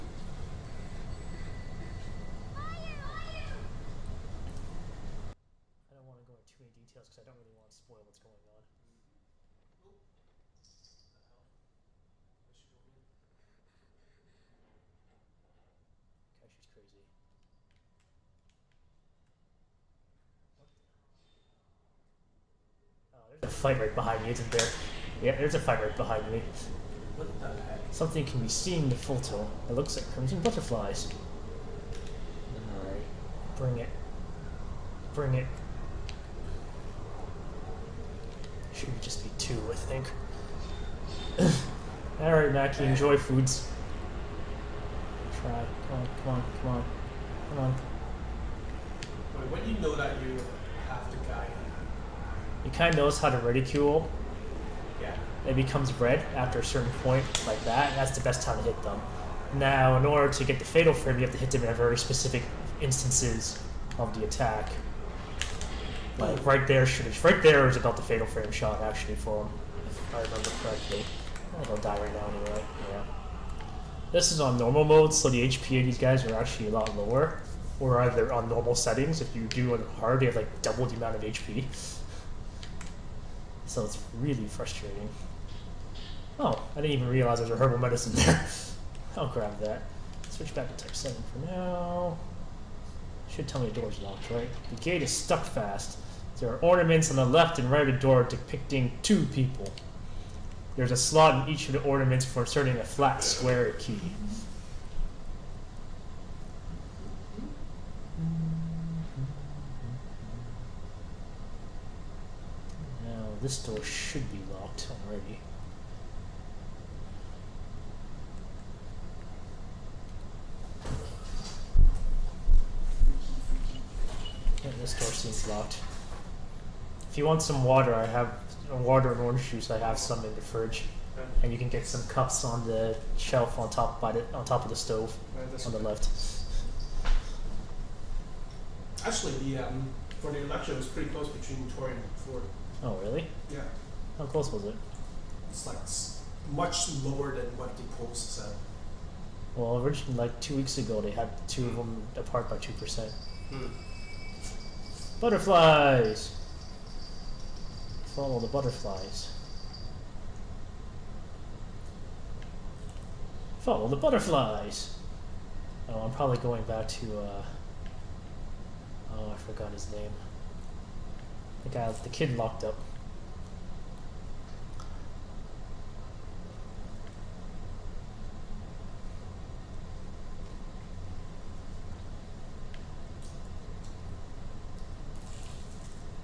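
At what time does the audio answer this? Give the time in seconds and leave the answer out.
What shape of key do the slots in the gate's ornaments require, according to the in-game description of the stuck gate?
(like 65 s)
102 s.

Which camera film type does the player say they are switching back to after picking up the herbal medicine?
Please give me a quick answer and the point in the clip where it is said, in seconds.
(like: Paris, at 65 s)
type 7, at 90 s.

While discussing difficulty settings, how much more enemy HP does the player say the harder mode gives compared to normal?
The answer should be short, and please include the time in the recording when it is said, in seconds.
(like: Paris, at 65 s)
double, at 80 s.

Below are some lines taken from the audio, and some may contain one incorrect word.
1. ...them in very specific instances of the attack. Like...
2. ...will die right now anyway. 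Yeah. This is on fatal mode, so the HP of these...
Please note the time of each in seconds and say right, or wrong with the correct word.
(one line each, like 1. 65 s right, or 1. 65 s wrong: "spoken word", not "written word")
1. 61 s right
2. 71 s wrong: "normal", not "fatal".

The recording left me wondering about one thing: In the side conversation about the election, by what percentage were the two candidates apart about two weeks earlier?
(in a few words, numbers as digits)
2%.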